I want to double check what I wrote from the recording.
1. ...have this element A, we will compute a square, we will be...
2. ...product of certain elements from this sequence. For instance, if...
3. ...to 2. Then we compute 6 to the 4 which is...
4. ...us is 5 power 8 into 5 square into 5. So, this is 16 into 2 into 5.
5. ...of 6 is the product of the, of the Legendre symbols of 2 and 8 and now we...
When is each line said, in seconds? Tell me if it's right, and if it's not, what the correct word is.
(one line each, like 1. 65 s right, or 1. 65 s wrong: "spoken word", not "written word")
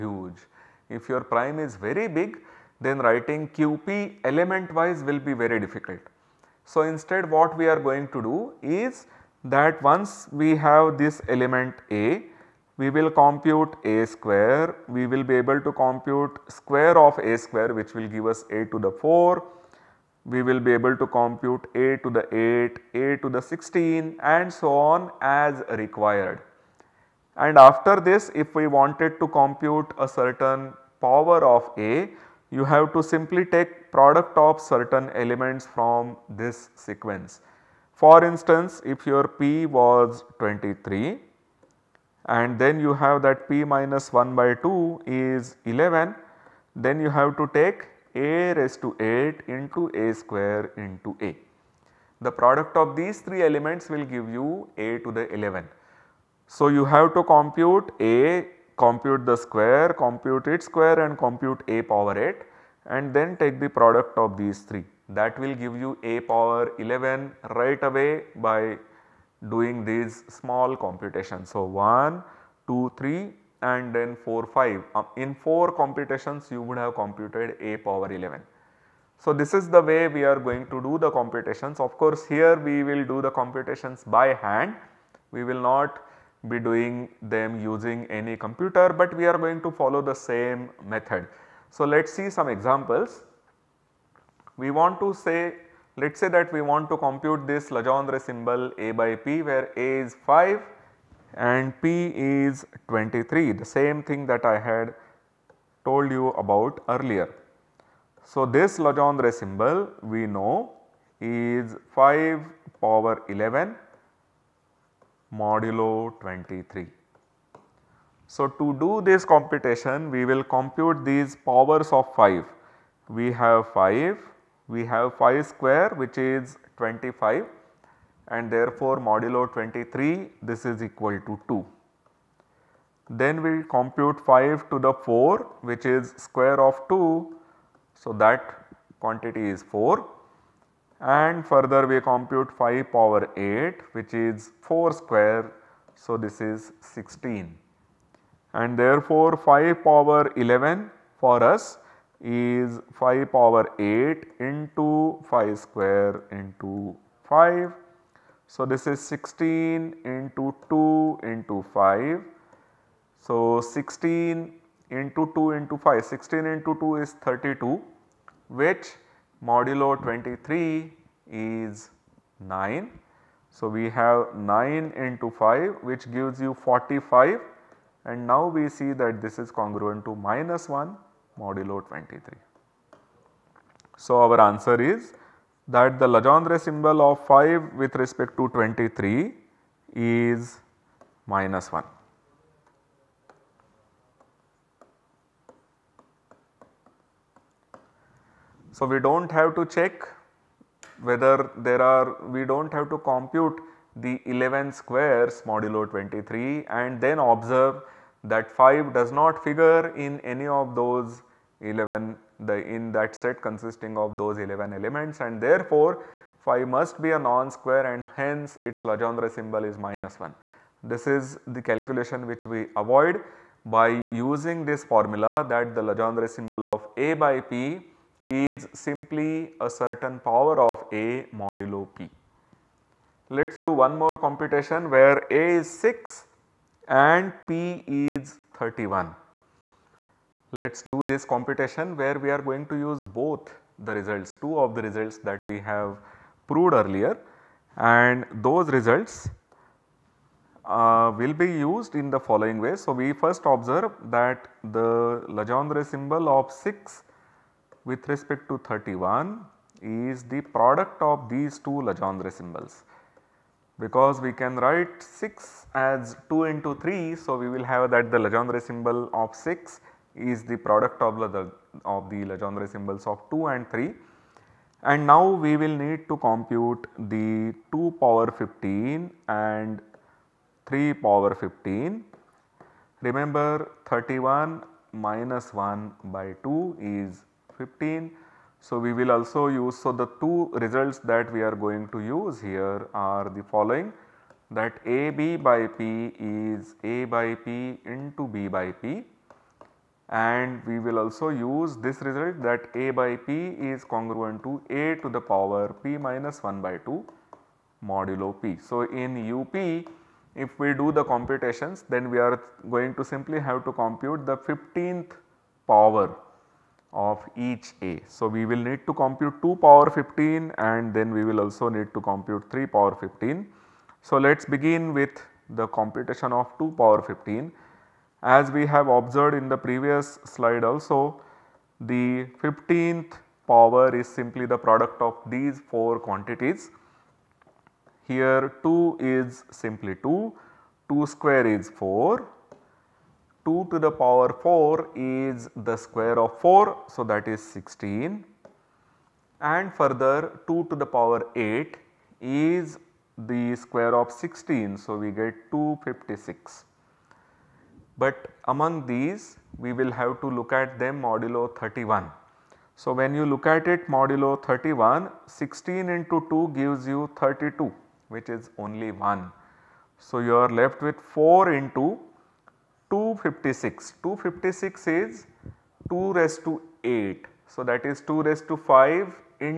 1. 10 s right
2. 33 s right
3. 131 s wrong: "5", not "6"
4. 151 s right
5. 269 s wrong: "3", not "8".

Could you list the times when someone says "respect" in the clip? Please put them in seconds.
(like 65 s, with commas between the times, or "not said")
187 s, 258 s.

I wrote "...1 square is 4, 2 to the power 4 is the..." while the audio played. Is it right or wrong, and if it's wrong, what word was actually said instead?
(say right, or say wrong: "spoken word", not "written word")
wrong: "2", not "1".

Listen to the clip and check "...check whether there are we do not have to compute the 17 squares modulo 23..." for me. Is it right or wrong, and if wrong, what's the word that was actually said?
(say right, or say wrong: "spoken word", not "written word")
wrong: "11", not "17".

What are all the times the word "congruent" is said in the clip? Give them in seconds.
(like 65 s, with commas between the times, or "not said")
179 s, 303 s.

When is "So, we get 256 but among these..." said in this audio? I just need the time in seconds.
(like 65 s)
354 s.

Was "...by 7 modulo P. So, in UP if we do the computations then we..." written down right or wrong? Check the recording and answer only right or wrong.
wrong.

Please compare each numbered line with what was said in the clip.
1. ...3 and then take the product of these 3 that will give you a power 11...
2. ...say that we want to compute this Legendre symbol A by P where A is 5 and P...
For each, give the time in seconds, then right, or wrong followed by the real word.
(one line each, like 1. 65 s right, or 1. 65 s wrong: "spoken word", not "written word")
1. 62 s wrong: "8", not "3"
2. 96 s right.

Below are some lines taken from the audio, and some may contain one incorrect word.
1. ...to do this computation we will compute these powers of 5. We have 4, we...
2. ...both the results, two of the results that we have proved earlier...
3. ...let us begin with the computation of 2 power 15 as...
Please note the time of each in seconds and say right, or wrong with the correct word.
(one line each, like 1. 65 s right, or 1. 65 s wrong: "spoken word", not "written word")
1. 118 s wrong: "5", not "4"
2. 243 s right
3. 324 s right.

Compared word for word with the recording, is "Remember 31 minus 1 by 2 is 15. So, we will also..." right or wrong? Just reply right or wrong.
right.